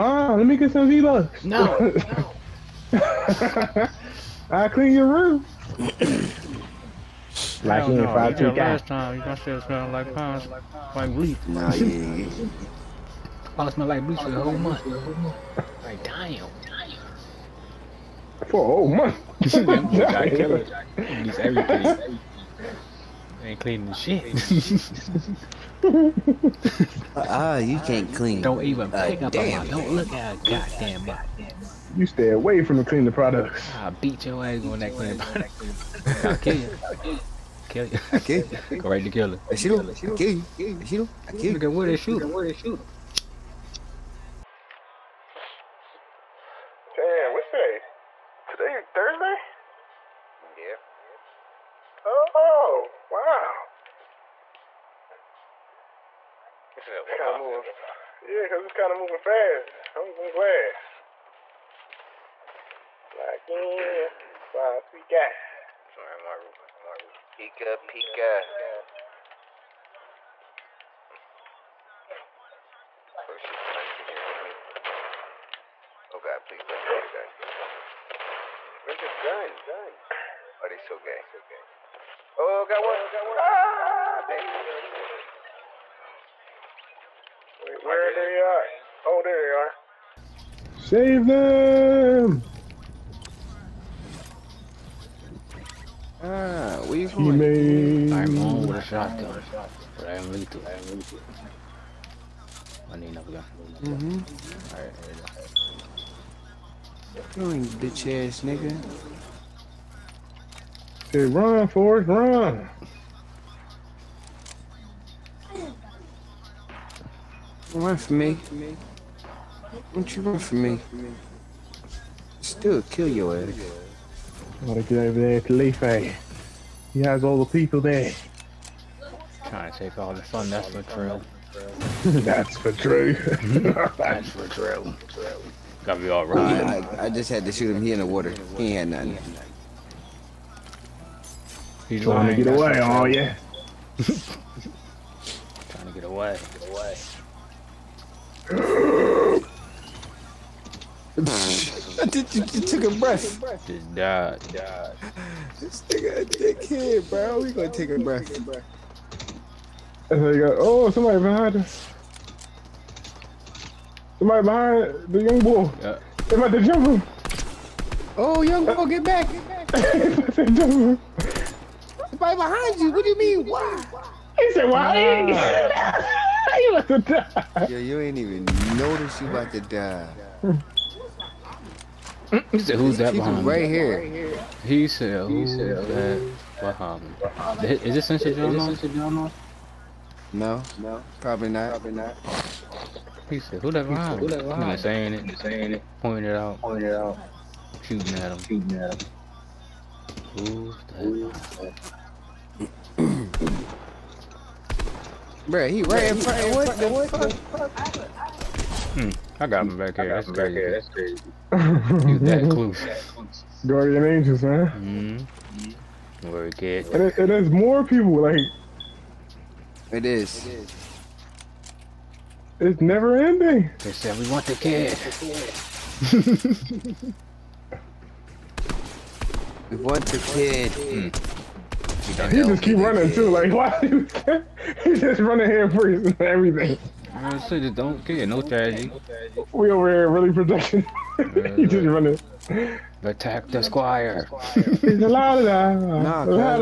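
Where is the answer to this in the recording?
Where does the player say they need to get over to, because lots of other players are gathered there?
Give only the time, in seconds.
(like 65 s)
125 s.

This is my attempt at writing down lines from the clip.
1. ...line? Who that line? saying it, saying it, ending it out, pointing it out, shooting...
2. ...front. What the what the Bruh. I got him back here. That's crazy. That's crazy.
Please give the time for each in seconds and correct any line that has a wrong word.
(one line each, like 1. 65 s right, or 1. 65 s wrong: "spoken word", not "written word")
1. 193 s wrong: "pointing", not "ending"
2. 206 s wrong: "Hmm", not "Bruh".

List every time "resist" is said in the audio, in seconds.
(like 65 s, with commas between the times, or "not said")
not said.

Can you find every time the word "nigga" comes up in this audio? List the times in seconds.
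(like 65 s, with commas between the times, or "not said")
108 s, 155 s.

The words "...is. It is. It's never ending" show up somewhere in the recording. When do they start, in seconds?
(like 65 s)
220 s.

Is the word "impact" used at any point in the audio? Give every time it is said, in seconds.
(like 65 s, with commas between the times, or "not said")
not said.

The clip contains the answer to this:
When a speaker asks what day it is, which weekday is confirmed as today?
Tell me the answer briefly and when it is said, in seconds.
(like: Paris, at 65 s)
Thursday, at 48 s.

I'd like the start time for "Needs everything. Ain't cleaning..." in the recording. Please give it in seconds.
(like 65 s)
20 s.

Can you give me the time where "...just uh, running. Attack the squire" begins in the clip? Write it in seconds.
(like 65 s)
241 s.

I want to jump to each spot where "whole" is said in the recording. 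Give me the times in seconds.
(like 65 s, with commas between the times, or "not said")
14 s, 18 s.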